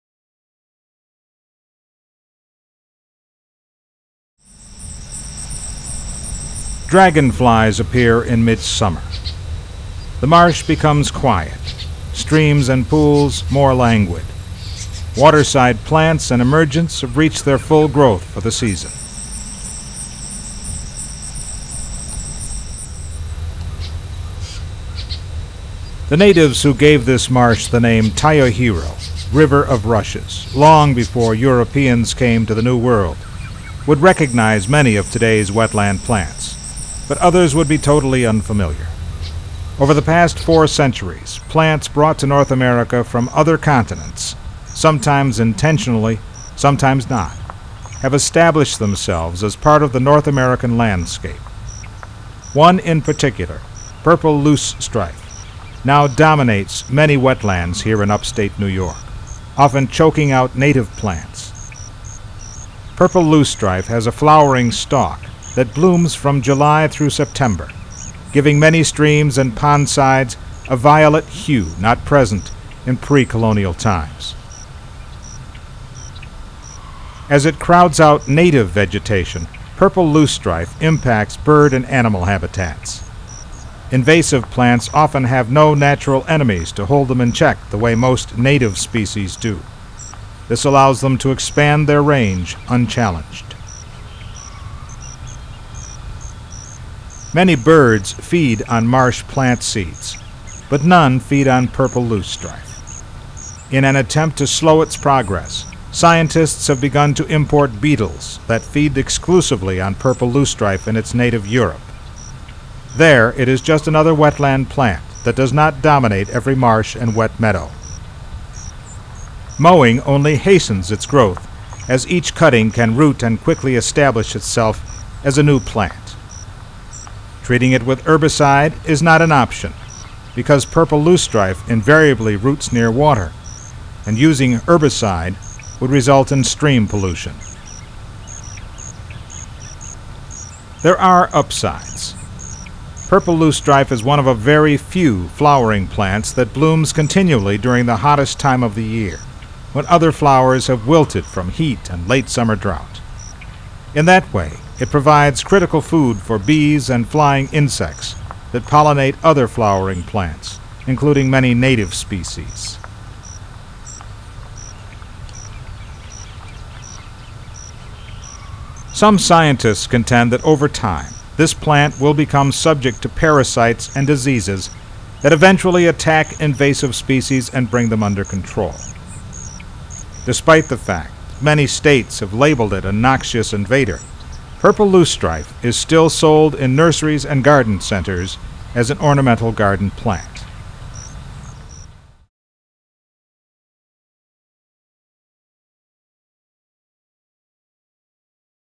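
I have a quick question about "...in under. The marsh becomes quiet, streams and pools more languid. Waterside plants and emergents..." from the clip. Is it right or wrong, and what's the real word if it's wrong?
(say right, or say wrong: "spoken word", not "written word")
wrong: "midsummer", not "under".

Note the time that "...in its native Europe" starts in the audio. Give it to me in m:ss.
1:50.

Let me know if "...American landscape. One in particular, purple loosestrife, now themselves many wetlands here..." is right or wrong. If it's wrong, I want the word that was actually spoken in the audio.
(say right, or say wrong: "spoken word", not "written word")
wrong: "dominates", not "themselves".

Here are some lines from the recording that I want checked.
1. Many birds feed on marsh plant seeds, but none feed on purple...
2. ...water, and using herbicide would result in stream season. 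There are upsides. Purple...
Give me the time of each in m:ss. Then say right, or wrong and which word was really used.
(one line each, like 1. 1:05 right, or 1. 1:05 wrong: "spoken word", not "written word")
1. 1:37 right
2. 2:12 wrong: "pollution", not "season".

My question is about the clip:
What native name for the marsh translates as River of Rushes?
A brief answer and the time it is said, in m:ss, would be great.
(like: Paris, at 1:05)
Tayohiro, at 0:28.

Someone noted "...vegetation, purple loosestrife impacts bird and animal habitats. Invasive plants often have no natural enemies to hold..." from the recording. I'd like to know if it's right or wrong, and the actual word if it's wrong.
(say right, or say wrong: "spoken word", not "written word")
right.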